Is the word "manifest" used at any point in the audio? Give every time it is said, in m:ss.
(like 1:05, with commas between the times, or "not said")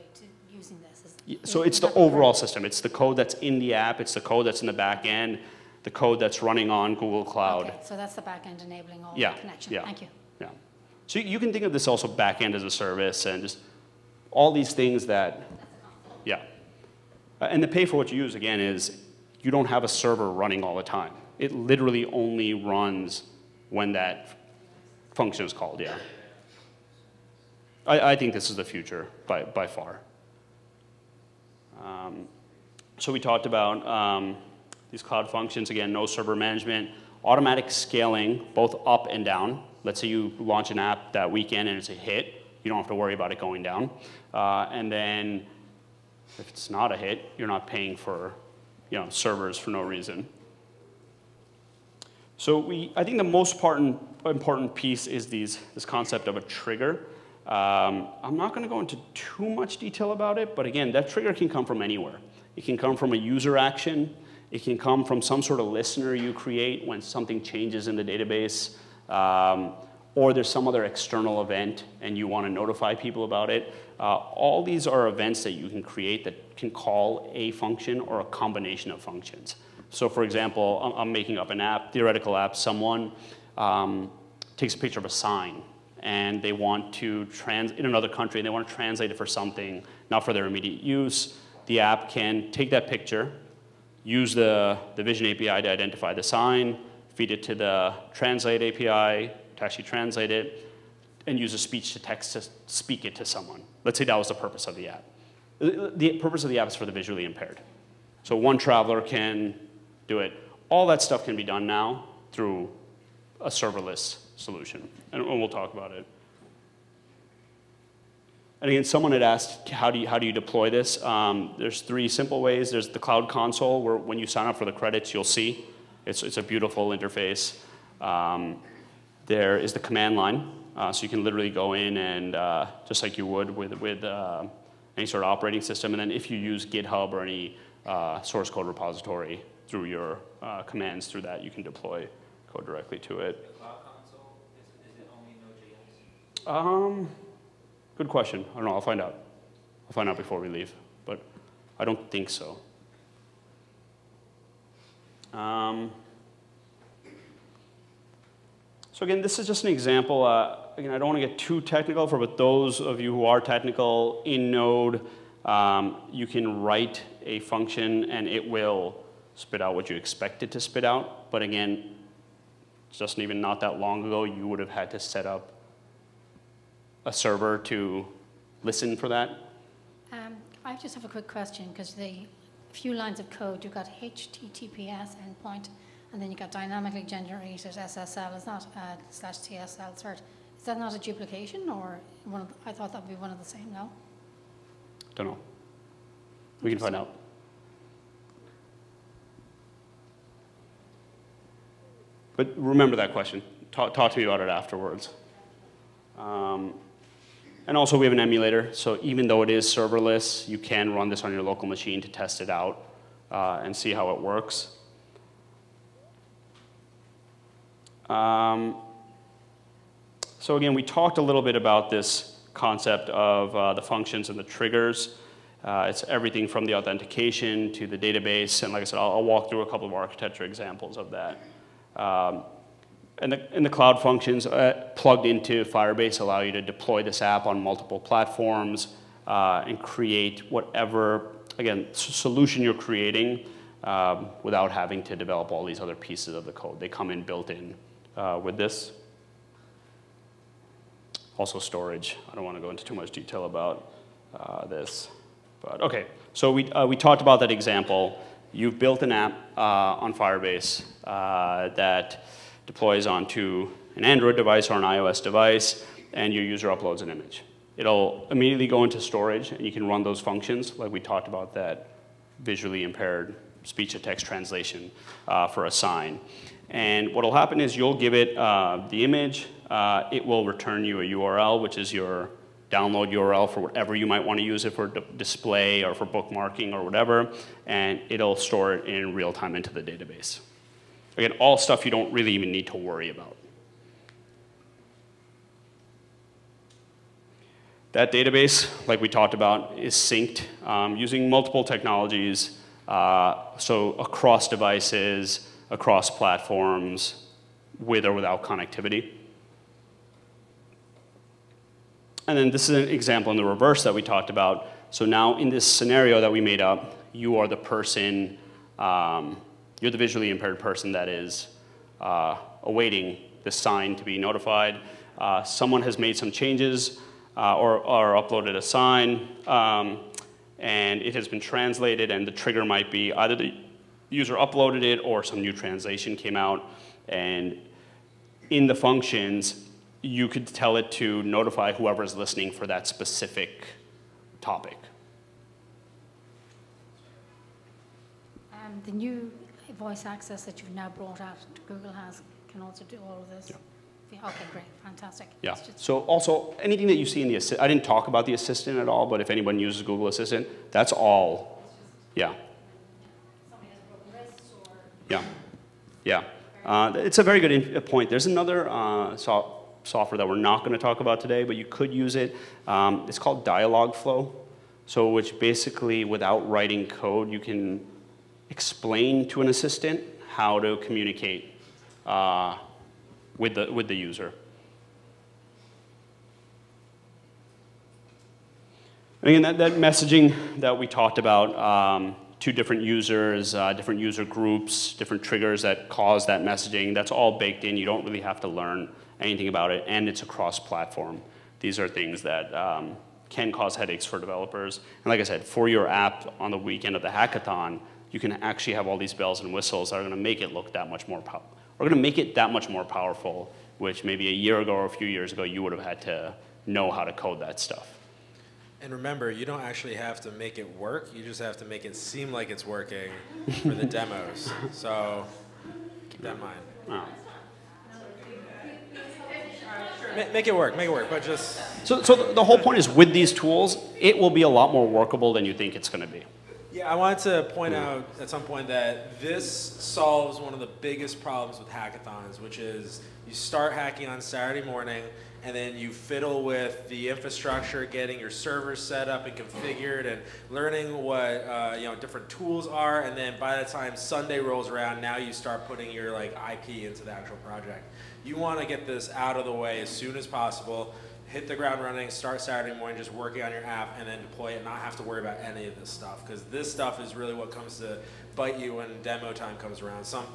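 not said.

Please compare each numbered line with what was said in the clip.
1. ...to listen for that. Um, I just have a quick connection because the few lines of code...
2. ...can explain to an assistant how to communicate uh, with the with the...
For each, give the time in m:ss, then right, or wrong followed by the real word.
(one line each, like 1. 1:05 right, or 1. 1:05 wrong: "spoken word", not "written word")
1. 2:57 wrong: "question", not "connection"
2. 6:17 right.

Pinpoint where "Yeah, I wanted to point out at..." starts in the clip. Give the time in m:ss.
7:16.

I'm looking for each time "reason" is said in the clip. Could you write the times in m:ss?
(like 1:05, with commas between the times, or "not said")
0:49.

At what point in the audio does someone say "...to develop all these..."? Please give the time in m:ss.
4:05.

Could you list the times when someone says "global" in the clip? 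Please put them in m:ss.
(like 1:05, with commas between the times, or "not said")
not said.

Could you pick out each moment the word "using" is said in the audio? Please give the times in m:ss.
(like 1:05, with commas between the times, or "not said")
0:00, 5:00.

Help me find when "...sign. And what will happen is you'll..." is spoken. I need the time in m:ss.
4:35.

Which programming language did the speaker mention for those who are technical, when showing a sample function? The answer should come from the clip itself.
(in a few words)
Node.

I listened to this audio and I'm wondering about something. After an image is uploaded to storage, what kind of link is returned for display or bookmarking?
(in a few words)
download URL.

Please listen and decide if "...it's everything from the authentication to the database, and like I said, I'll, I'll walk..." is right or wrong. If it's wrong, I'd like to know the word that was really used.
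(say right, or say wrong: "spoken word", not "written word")
right.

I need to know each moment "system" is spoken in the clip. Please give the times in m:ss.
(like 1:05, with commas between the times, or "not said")
0:02, 2:15.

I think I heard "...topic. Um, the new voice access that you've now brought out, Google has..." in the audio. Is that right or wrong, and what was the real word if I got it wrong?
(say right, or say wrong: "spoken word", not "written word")
right.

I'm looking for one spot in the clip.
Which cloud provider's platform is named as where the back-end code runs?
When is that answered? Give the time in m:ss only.
0:06.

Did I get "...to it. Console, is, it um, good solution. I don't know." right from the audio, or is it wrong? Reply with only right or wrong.
wrong.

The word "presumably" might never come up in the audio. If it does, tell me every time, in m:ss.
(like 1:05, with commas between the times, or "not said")
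not said.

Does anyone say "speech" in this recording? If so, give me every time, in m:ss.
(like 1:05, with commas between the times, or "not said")
1:41, 4:33.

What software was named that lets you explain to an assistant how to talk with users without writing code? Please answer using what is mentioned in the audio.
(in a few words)
Dialogflow.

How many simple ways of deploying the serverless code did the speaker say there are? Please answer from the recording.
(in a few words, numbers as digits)
3.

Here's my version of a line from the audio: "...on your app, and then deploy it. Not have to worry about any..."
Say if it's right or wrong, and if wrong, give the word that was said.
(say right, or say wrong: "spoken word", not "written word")
right.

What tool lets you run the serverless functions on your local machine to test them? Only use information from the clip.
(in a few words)
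emulator.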